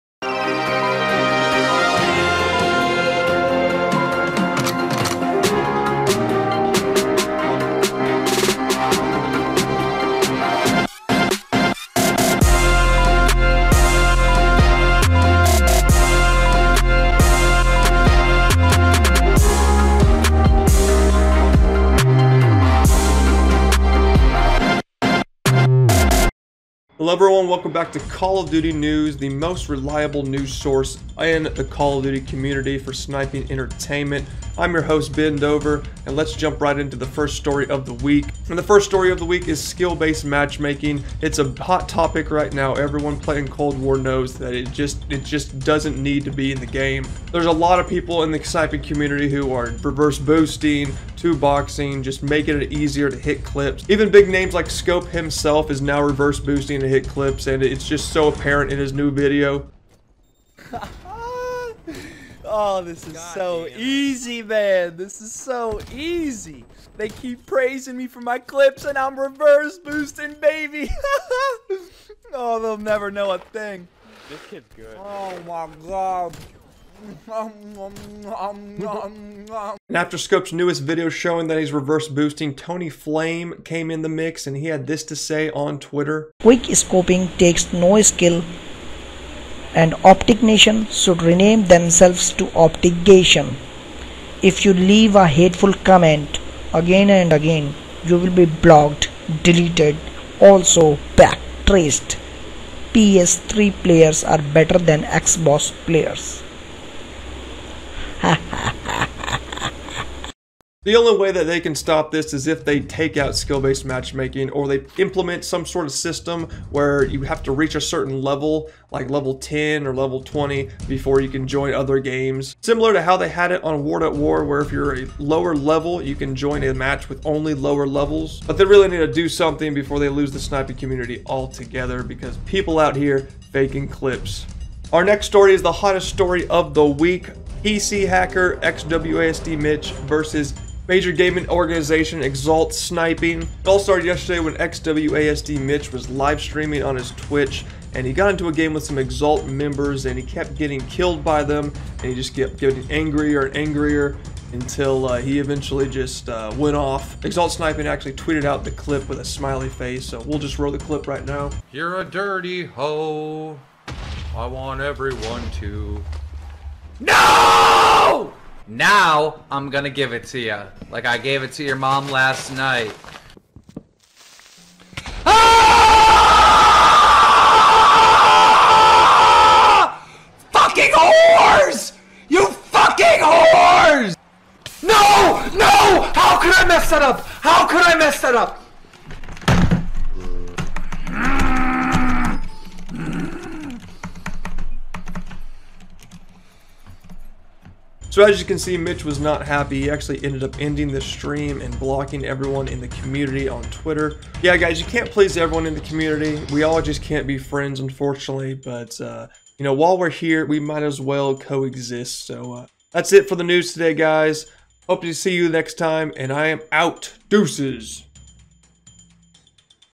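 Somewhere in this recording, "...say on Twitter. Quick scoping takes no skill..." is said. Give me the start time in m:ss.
1:25.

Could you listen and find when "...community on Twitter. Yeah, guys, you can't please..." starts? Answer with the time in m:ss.
3:22.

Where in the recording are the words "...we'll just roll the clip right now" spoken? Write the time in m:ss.
2:40.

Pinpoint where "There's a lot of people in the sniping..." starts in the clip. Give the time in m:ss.
0:47.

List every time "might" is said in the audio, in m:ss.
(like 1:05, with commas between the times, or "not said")
3:30.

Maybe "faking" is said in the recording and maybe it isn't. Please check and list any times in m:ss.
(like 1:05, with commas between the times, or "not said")
2:13.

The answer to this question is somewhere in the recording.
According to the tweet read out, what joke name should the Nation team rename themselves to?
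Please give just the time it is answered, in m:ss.
1:32.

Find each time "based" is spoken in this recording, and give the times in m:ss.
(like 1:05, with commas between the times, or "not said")
0:39, 1:53.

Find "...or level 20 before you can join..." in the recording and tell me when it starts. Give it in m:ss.
1:59.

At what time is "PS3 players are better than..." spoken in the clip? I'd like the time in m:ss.
1:42.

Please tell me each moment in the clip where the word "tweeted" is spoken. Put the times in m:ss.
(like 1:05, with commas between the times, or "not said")
2:38.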